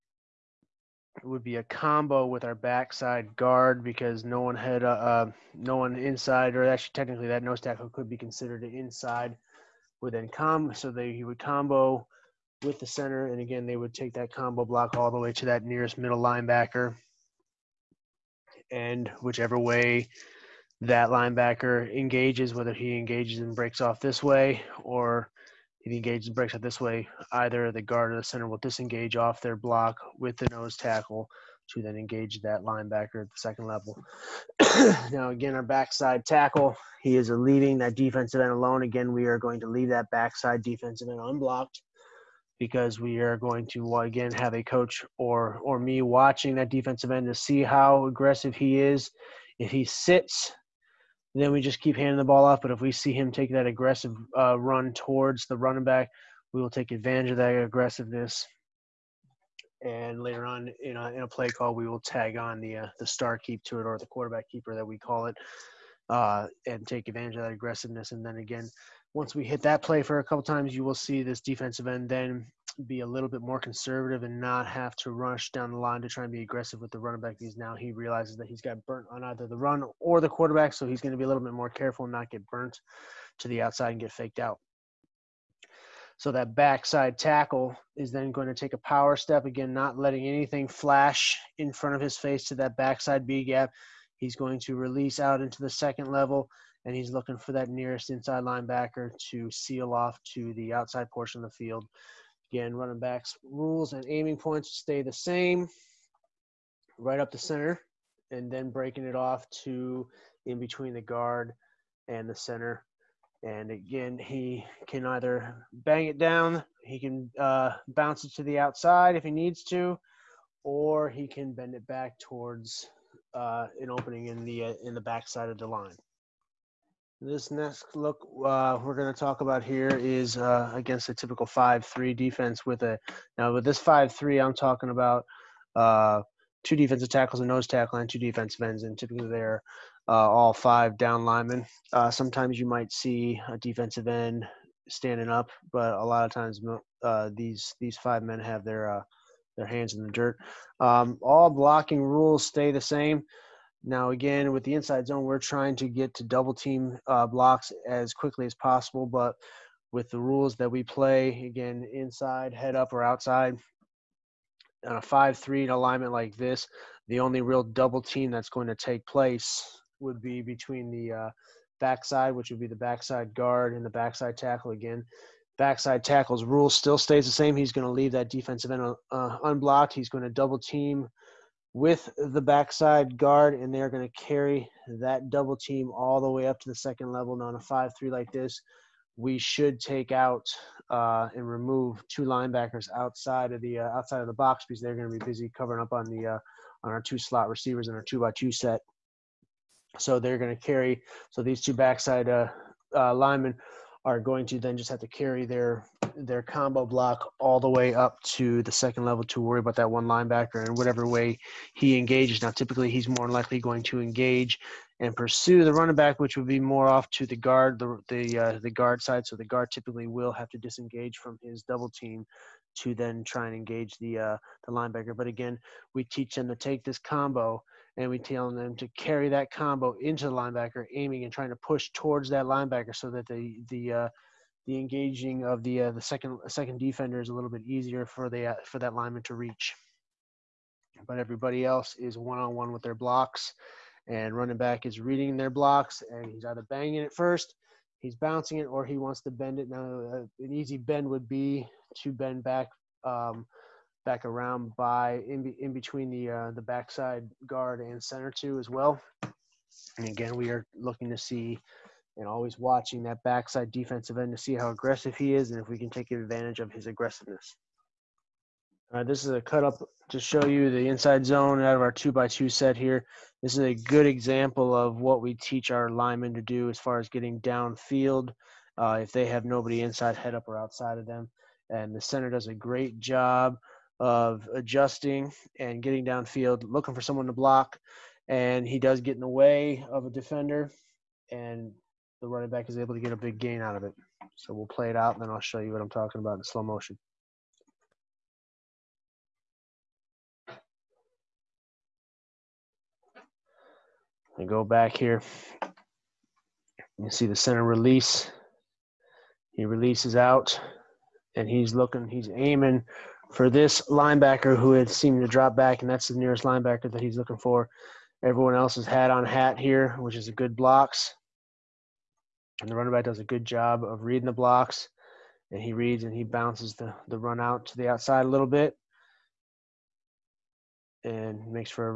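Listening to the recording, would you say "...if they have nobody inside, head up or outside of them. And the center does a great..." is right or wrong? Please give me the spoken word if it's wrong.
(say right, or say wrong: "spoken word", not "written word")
right.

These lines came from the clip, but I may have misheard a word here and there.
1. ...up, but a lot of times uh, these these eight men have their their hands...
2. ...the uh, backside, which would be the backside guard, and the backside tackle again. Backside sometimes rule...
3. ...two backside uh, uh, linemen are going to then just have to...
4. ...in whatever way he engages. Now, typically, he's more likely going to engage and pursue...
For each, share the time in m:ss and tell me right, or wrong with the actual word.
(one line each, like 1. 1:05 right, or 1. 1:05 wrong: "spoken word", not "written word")
1. 2:25 wrong: "five", not "eight"
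2. 2:50 wrong: "tackles", not "sometimes"
3. 3:21 right
4. 3:30 right.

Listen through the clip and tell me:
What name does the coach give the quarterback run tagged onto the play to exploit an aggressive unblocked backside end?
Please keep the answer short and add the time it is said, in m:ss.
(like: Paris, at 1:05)
star keep, at 1:03.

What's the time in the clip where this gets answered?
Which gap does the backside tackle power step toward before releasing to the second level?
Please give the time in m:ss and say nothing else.
1:32.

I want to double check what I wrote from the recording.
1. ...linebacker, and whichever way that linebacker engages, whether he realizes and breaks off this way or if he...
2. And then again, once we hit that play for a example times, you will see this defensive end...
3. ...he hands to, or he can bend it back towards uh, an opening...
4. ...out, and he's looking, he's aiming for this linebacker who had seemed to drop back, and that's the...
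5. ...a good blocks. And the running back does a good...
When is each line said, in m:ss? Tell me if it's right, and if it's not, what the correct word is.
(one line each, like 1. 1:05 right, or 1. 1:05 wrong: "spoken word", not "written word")
1. 0:16 wrong: "engages", not "realizes"
2. 1:08 wrong: "couple", not "example"
3. 1:59 wrong: "needs", not "hands"
4. 5:10 right
5. 5:20 right.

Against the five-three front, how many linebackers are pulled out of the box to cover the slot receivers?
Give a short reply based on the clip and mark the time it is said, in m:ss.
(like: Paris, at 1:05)
2, at 3:12.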